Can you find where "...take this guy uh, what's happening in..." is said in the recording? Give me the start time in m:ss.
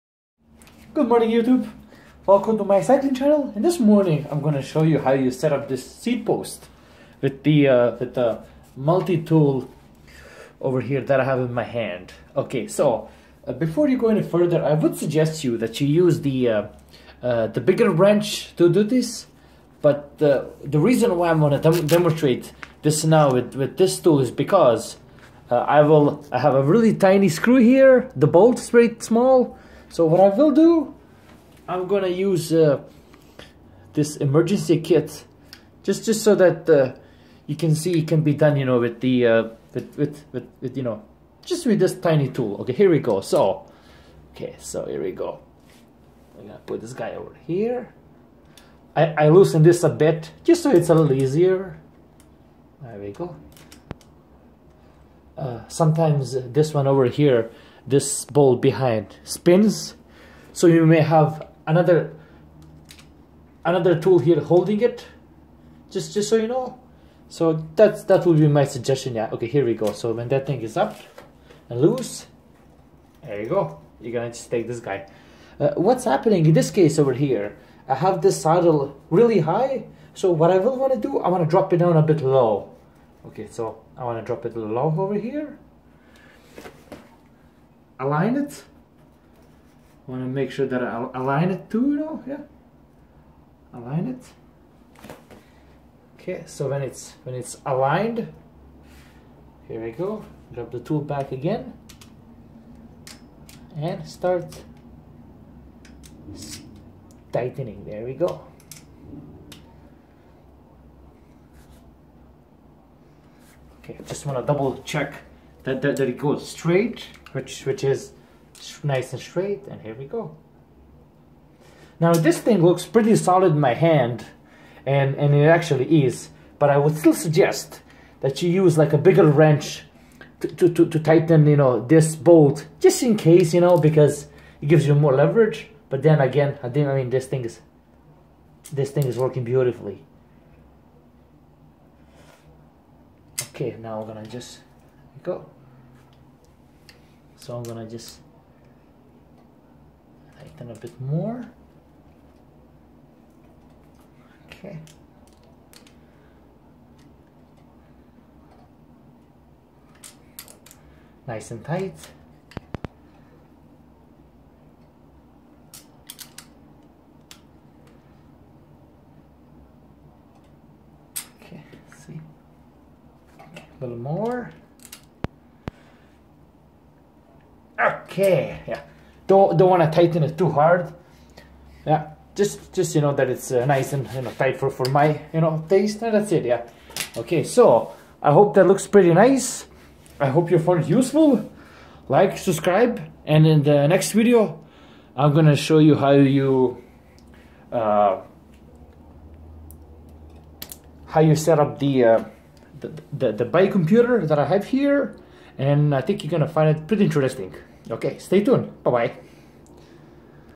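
1:14.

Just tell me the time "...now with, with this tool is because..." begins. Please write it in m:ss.
0:23.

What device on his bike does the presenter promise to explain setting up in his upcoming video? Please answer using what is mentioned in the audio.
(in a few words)
bike computer.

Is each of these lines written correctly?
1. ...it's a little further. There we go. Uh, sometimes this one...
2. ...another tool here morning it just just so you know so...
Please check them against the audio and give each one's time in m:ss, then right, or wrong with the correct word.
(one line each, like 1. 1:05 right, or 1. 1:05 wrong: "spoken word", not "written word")
1. 0:50 wrong: "easier", not "further"
2. 1:03 wrong: "holding", not "morning".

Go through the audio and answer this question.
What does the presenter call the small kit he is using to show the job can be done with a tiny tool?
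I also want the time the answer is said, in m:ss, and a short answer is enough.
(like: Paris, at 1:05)
emergency kit, at 0:34.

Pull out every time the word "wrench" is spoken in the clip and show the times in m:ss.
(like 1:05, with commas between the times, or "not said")
0:17, 2:09.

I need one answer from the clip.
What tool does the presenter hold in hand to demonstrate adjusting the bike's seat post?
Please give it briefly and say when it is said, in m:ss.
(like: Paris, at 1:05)
multi-tool, at 0:08.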